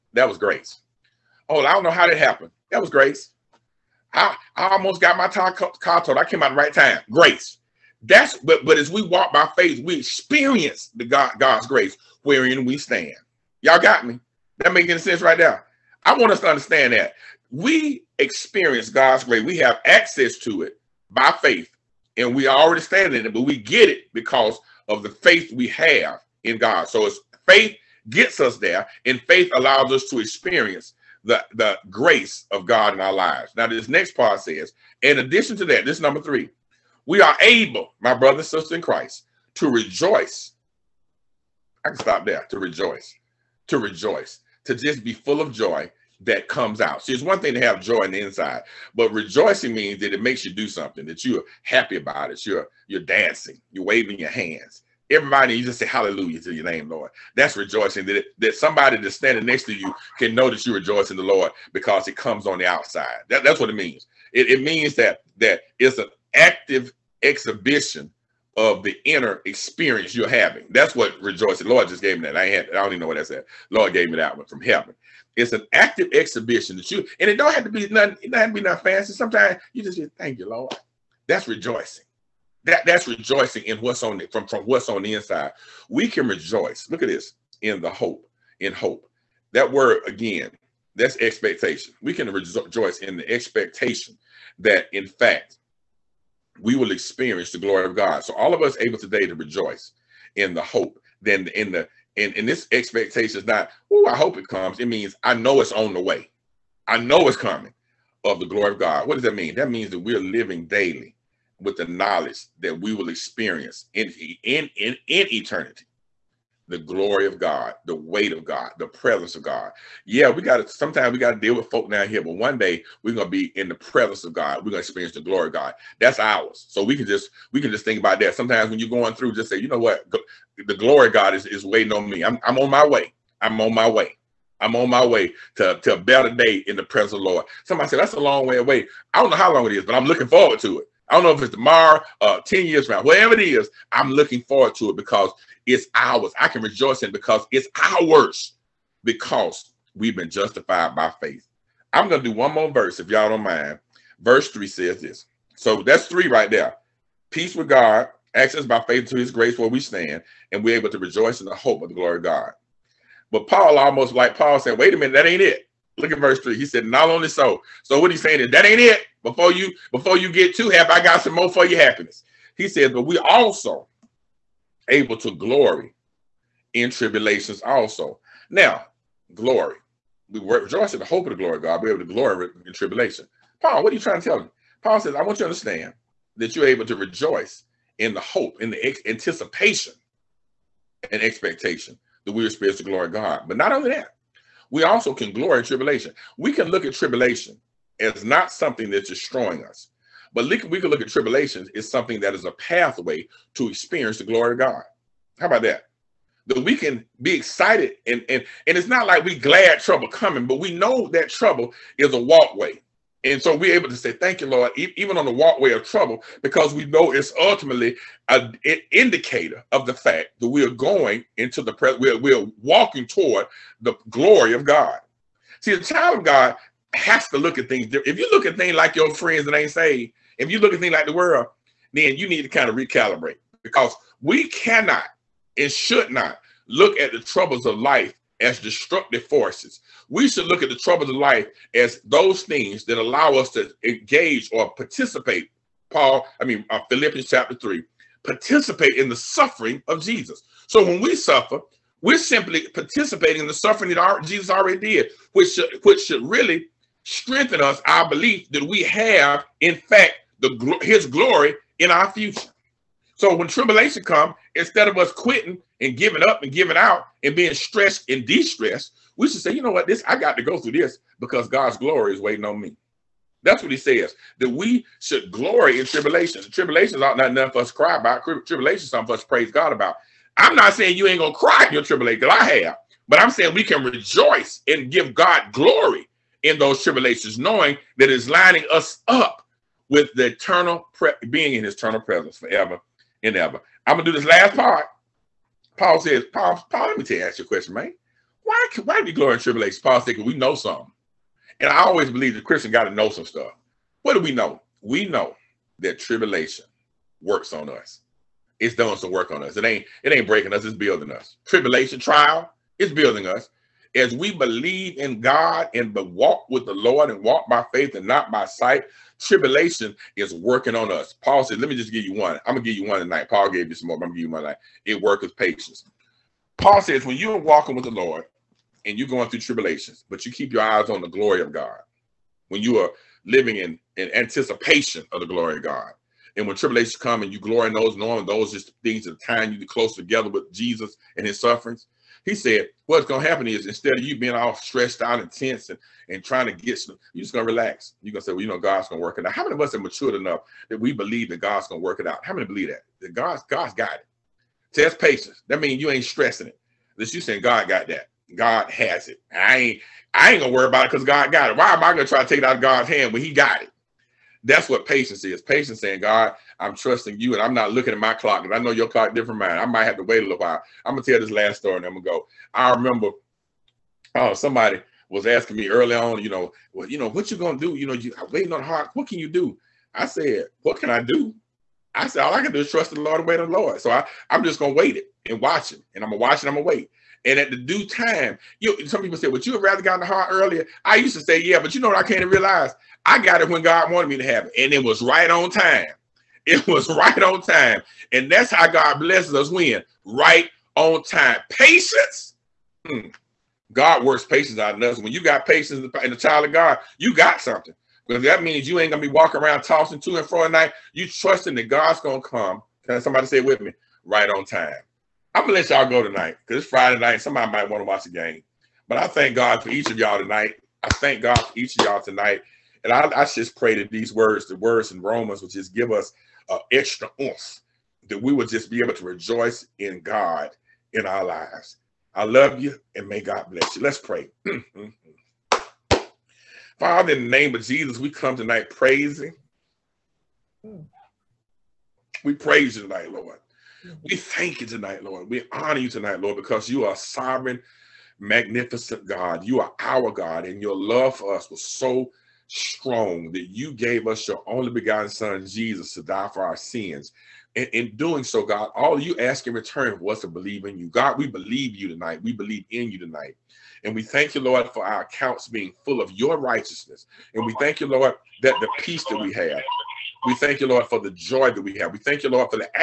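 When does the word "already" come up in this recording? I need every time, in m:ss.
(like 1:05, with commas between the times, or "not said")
0:22, 4:14.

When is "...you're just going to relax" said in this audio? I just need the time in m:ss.
5:47.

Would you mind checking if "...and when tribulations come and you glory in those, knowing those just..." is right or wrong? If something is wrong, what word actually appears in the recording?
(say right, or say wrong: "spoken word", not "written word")
right.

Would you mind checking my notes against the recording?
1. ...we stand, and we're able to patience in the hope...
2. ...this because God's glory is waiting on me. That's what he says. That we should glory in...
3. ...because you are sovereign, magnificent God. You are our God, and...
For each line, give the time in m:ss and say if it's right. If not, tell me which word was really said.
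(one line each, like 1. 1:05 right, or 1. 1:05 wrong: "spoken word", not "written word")
1. 2:39 wrong: "rejoice", not "patience"
2. 4:30 right
3. 7:26 right.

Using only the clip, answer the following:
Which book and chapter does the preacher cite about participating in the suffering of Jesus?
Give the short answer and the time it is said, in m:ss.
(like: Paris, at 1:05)
Philippians chapter 3, at 4:06.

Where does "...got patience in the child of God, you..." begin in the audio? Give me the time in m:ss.
6:45.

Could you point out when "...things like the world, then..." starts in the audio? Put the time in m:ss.
3:50.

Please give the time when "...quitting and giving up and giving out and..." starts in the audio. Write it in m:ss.
4:25.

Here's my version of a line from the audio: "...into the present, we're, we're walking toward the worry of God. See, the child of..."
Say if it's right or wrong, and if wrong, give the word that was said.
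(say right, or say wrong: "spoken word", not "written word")
wrong: "glory", not "worry".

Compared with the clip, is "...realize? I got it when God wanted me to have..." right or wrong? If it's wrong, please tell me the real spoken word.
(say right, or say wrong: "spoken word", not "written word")
right.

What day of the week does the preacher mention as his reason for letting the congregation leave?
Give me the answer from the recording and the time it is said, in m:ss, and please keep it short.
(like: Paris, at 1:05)
Friday, at 6:56.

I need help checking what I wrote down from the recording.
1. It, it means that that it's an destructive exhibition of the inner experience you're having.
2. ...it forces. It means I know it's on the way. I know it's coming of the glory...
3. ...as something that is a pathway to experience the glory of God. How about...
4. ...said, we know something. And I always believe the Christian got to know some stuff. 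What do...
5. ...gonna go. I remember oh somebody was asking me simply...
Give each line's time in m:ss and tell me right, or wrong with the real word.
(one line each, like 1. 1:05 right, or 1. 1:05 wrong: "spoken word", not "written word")
1. 1:04 wrong: "active", not "destructive"
2. 1:44 wrong: "comes", not "forces"
3. 3:21 right
4. 5:00 right
5. 6:11 wrong: "early", not "simply".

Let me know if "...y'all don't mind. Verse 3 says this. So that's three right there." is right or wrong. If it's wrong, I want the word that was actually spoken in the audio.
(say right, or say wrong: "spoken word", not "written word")
right.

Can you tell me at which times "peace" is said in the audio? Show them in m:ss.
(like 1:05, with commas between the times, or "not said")
2:37, 7:48.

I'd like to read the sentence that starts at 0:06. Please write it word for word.
I came out the right time.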